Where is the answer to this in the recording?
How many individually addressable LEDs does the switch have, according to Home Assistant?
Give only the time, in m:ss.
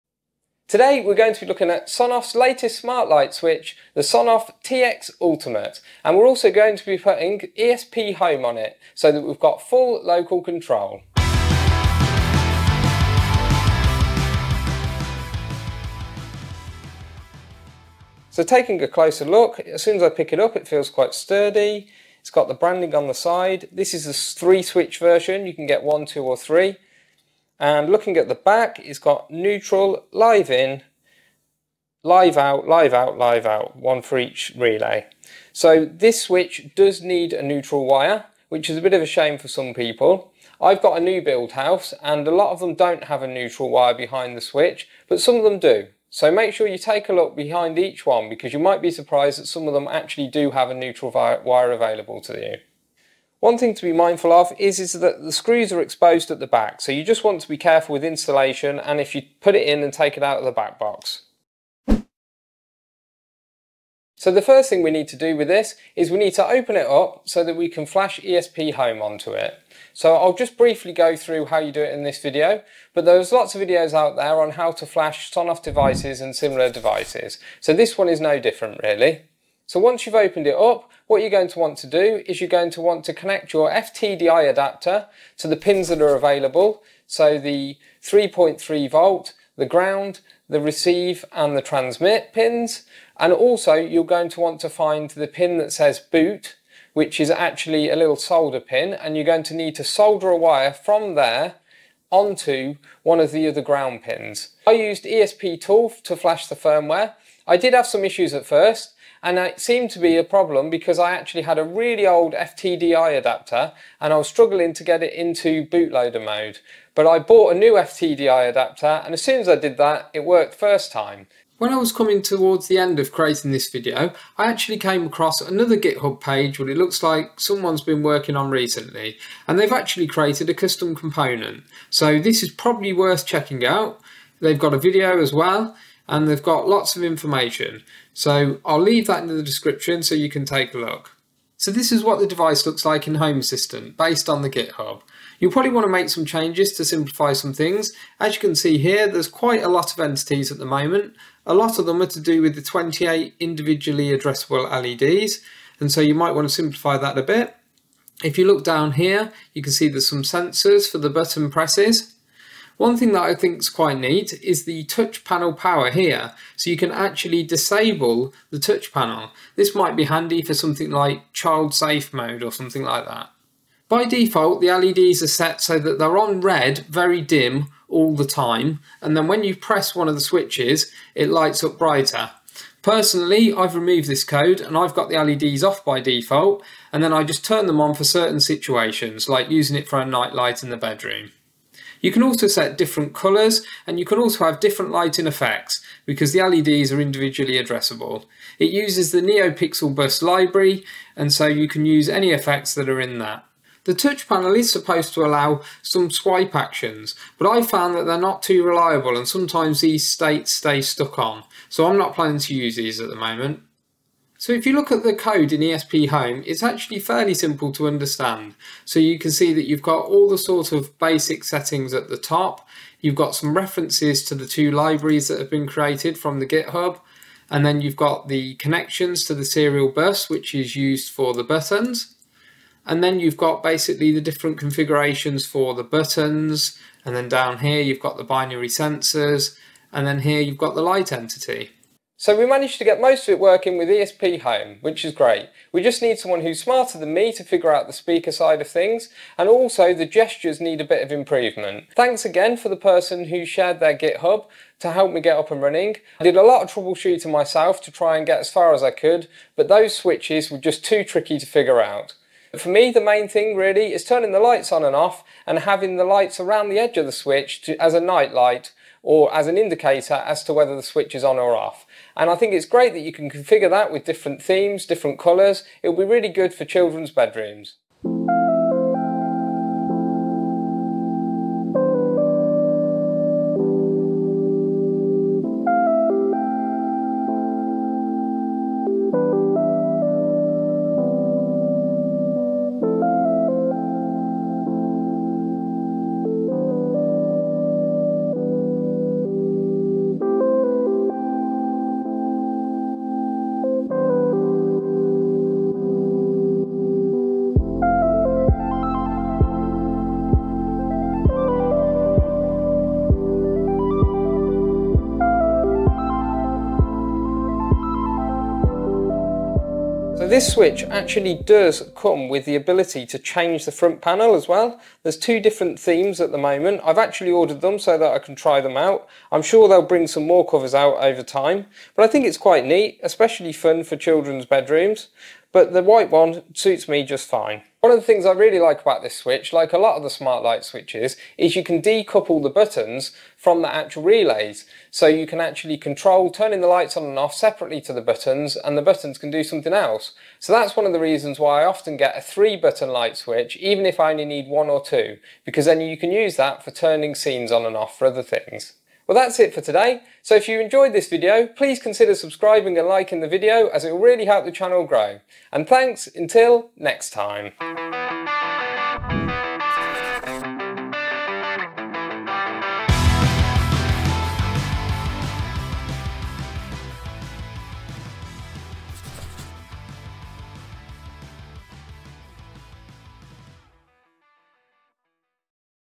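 2:32.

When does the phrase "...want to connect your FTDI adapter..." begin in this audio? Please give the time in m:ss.
1:22.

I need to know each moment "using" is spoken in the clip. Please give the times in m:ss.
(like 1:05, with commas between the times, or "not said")
3:09.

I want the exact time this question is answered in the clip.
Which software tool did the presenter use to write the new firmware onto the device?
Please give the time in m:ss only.
1:45.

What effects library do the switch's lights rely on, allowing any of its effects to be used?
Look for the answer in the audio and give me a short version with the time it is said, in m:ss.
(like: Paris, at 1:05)
NeoPixel Bus, at 3:19.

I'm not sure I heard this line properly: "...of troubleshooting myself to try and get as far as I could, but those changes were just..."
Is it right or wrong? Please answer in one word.
wrong.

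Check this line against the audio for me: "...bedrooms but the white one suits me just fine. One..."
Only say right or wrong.
right.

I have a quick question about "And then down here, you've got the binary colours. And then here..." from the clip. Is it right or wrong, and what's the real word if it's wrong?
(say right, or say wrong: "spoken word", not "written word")
wrong: "sensors", not "colours".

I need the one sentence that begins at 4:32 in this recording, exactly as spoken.
And I think it's great that you can configure that with different themes, different colours.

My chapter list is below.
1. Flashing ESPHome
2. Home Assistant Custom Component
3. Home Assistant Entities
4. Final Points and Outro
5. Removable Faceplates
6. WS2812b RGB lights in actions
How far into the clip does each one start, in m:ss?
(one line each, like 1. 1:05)
1. 1:01
2. 2:01
3. 2:21
4. 5:37
5. 5:20
6. 4:37.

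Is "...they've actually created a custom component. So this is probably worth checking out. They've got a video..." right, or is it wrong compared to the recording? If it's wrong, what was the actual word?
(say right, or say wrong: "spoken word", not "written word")
right.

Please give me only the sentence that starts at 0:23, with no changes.
This is the three switch version, you can get one, two or three.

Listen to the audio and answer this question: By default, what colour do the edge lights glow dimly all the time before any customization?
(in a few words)
Red.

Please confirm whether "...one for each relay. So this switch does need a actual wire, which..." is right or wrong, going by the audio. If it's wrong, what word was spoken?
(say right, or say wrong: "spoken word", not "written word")
wrong: "neutral", not "actual".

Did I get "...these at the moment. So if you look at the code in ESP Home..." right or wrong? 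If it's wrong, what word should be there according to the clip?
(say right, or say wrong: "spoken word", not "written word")
right.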